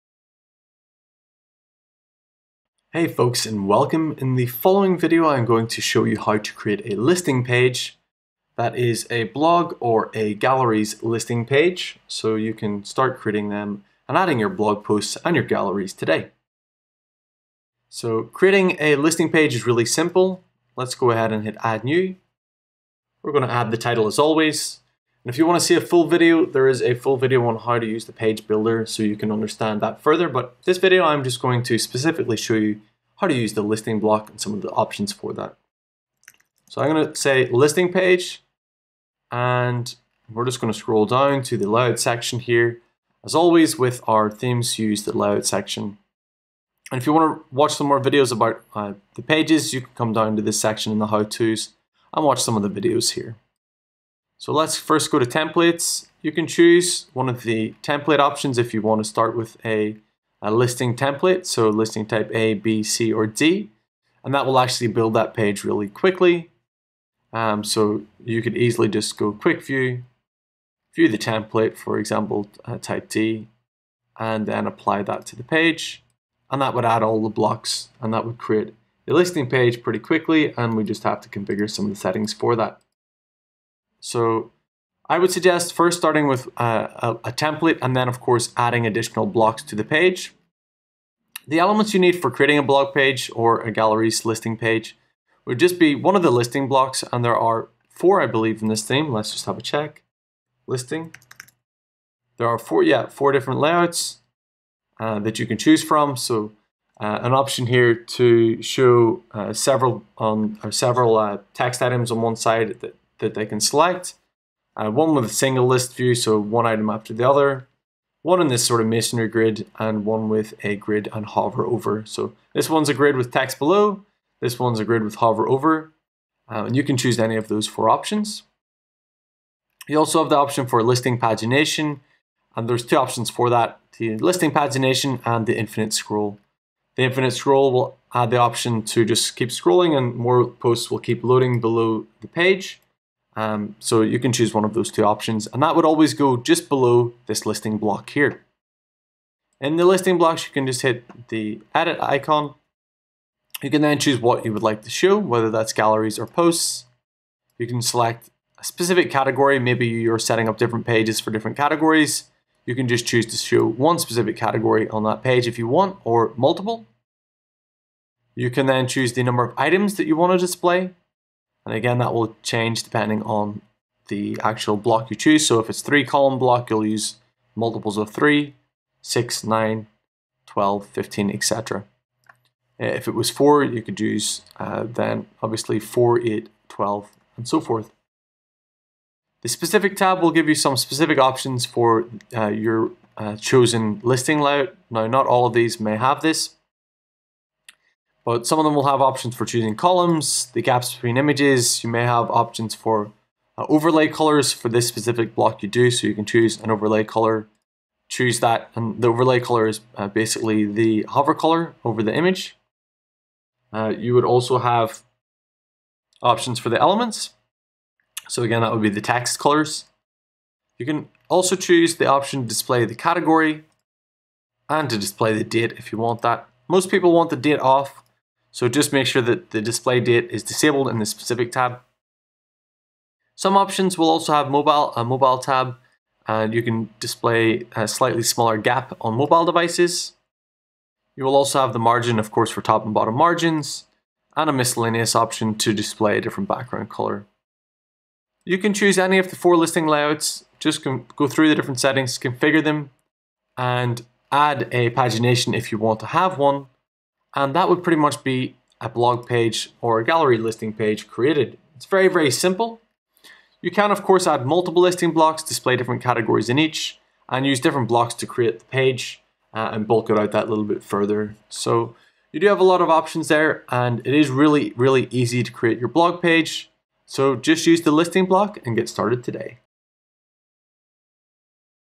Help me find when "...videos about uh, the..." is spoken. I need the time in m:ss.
0:48.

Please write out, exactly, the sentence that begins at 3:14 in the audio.
Now, not all of these may have this, but some of them will have options for choosing columns, the gaps between images.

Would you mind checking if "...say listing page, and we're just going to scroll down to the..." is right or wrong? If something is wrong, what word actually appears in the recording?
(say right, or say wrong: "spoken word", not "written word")
right.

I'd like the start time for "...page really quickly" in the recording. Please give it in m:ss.
1:05.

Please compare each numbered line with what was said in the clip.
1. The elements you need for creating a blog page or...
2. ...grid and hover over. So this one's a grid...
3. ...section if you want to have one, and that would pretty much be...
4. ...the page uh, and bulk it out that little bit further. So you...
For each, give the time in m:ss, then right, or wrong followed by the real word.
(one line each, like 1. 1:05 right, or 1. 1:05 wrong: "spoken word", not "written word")
1. 1:31 right
2. 2:00 right
3. 4:14 wrong: "pagination", not "section"
4. 4:28 right.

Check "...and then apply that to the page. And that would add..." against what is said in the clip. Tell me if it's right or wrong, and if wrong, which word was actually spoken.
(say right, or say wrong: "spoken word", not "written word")
right.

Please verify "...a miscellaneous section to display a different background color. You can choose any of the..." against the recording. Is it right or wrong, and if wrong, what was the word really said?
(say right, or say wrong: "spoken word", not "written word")
wrong: "option", not "section".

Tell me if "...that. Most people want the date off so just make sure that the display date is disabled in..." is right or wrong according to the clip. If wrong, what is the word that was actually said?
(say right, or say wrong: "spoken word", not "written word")
right.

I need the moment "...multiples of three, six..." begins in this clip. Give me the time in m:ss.
2:57.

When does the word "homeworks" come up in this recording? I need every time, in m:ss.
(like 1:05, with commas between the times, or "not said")
not said.